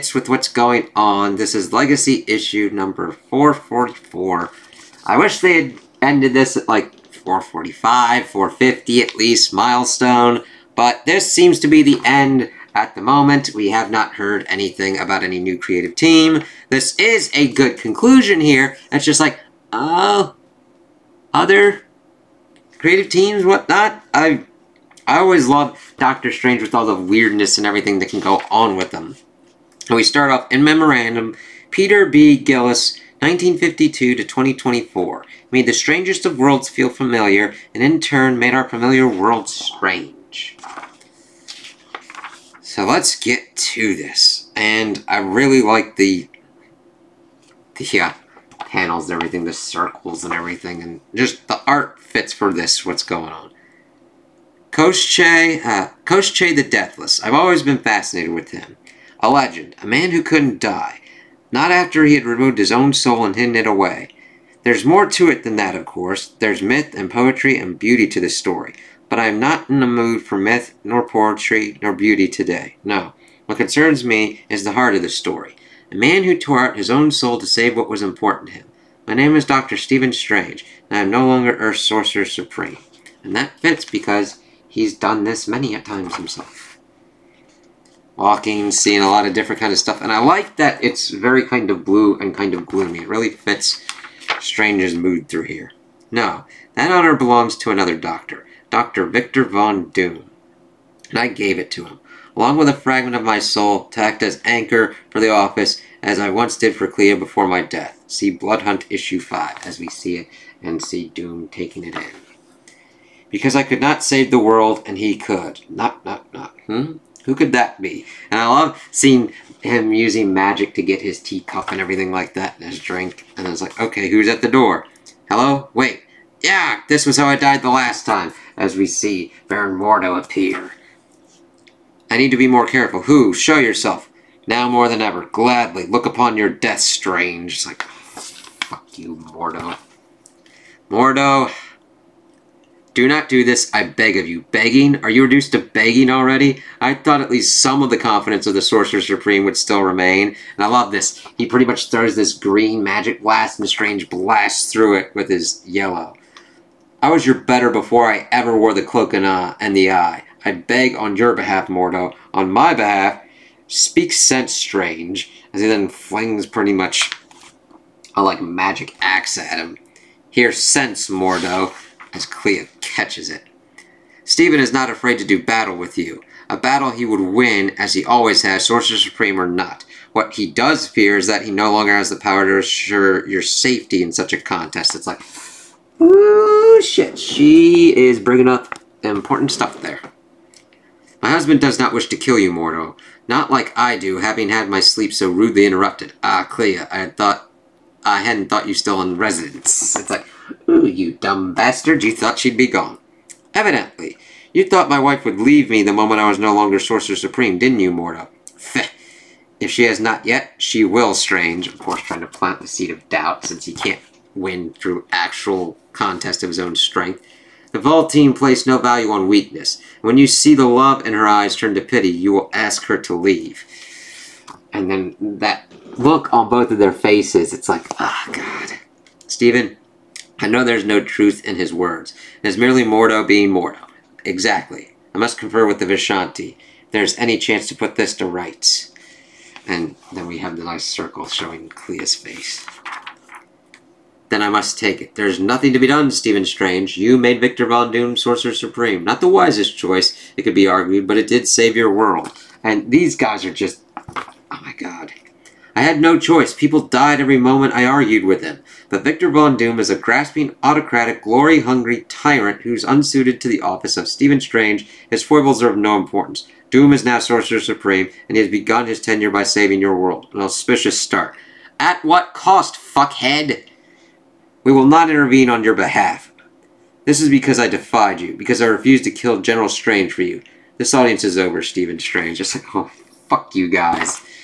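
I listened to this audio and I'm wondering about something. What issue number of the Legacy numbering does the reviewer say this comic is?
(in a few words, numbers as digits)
444.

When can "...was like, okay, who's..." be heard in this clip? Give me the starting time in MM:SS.
02:03.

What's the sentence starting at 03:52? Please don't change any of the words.
It is merely Mordo being Mordo.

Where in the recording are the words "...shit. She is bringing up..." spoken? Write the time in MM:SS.
03:06.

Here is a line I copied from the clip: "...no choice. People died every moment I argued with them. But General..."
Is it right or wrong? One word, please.
wrong.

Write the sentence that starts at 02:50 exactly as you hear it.
Here, sense, Mordo, as Clea catches it.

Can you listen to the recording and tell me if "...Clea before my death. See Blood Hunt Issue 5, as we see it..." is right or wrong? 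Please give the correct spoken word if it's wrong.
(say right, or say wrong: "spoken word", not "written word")
right.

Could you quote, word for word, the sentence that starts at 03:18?
I hadn't thought you still in residence.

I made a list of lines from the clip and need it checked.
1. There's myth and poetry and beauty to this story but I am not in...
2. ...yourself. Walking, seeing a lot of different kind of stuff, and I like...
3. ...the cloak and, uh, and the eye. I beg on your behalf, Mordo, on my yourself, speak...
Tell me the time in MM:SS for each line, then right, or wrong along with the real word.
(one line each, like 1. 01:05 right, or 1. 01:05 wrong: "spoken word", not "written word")
1. 01:06 right
2. 01:26 wrong: "himself", not "yourself"
3. 02:38 wrong: "behalf", not "yourself".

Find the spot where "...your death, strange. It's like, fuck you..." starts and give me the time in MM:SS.
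02:16.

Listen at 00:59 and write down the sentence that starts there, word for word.
A legend, a man who couldn't die.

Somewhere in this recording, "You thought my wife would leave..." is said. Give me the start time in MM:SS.
03:24.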